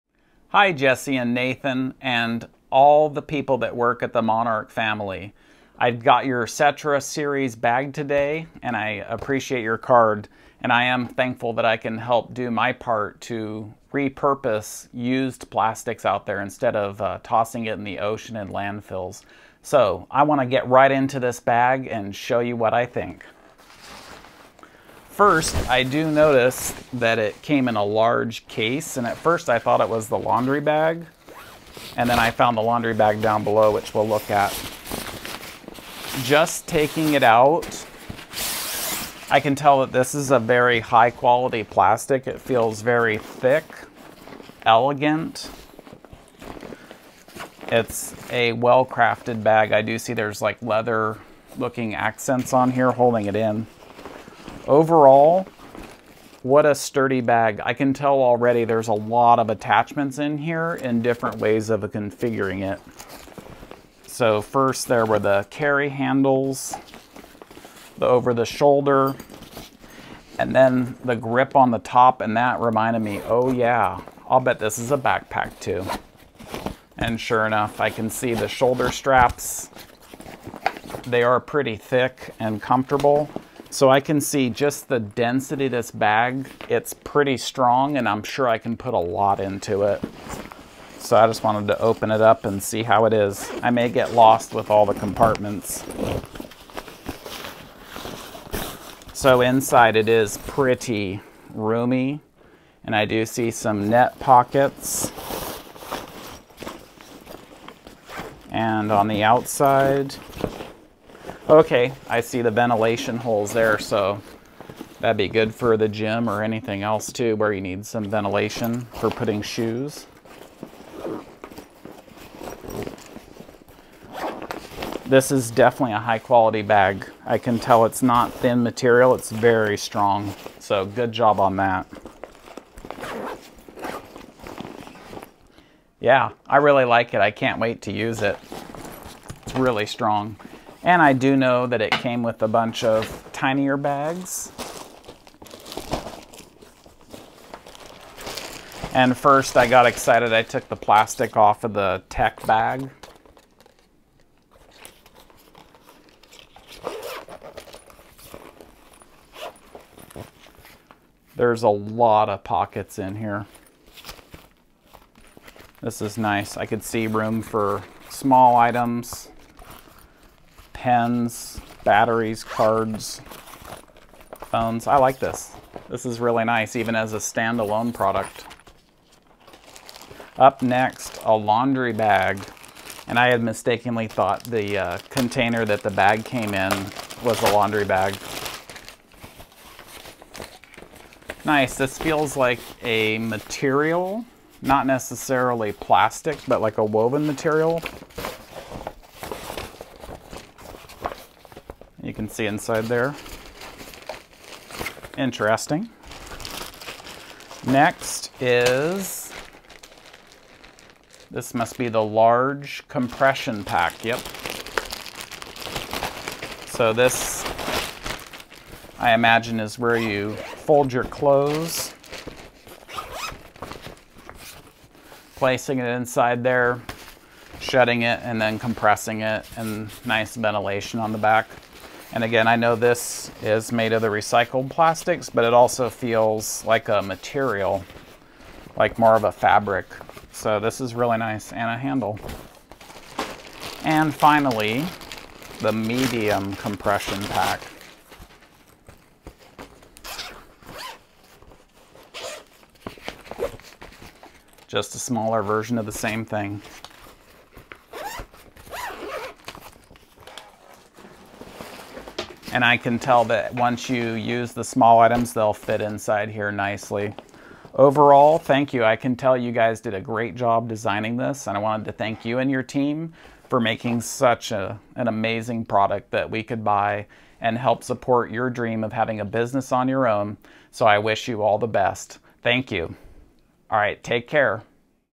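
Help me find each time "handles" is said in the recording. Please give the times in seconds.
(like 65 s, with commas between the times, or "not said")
65 s, 241 s.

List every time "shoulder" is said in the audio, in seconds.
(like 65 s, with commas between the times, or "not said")
68 s, 78 s.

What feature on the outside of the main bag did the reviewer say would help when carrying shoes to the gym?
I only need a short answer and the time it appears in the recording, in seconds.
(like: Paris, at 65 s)
ventilation holes, at 112 s.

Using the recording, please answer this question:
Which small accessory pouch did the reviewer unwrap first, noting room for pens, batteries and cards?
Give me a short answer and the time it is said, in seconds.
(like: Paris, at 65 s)
tech bag, at 152 s.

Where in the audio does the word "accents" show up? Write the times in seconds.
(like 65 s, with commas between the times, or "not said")
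51 s.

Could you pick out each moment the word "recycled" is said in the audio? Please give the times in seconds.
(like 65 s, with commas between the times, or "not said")
234 s.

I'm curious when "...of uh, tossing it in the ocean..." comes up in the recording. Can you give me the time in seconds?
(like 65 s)
16 s.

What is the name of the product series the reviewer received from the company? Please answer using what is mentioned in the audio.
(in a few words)
Settra series.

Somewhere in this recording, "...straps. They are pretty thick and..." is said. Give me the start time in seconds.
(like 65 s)
78 s.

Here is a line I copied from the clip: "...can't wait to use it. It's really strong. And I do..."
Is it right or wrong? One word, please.
right.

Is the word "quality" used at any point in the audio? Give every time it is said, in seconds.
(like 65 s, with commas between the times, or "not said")
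41 s, 126 s.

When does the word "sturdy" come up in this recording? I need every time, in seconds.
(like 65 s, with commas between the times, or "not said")
56 s.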